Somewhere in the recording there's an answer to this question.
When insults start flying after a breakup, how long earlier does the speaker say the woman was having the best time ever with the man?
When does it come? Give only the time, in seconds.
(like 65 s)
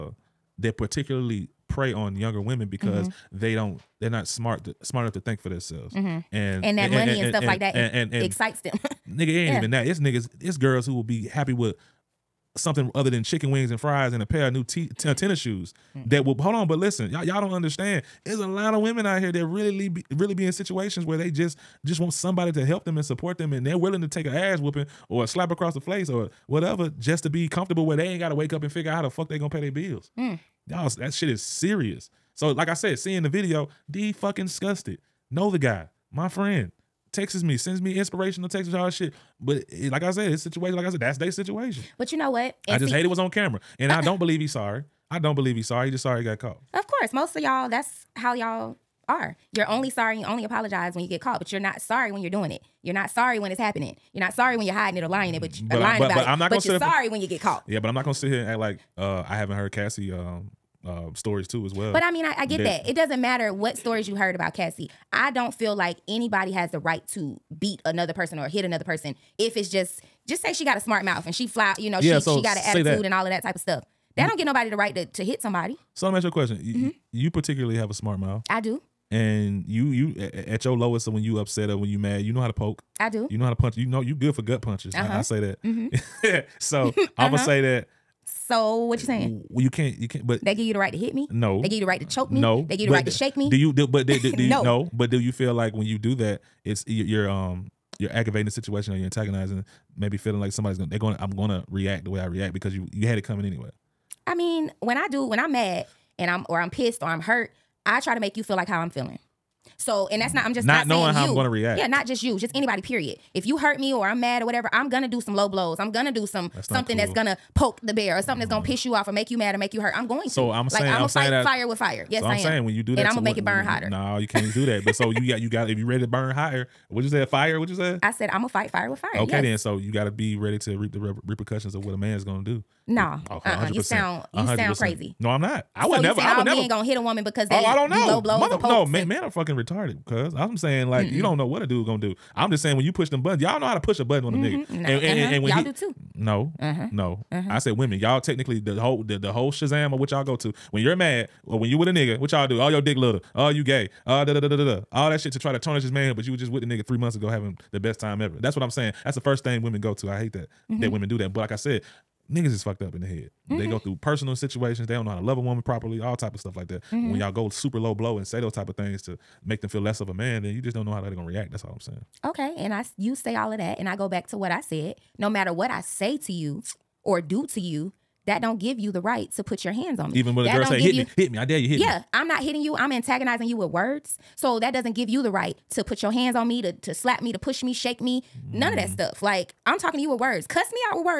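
156 s.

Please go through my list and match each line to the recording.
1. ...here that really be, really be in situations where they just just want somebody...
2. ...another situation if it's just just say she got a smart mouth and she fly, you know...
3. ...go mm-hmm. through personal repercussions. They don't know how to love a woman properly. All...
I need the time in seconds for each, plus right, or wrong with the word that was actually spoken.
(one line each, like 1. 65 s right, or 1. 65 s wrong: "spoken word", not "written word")
1. 19 s right
2. 68 s wrong: "person", not "situation"
3. 163 s wrong: "situations", not "repercussions".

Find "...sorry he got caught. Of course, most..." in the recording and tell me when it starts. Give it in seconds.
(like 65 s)
46 s.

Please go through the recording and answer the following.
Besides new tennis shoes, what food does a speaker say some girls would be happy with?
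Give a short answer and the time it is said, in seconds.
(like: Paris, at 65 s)
chicken wings and fries, at 13 s.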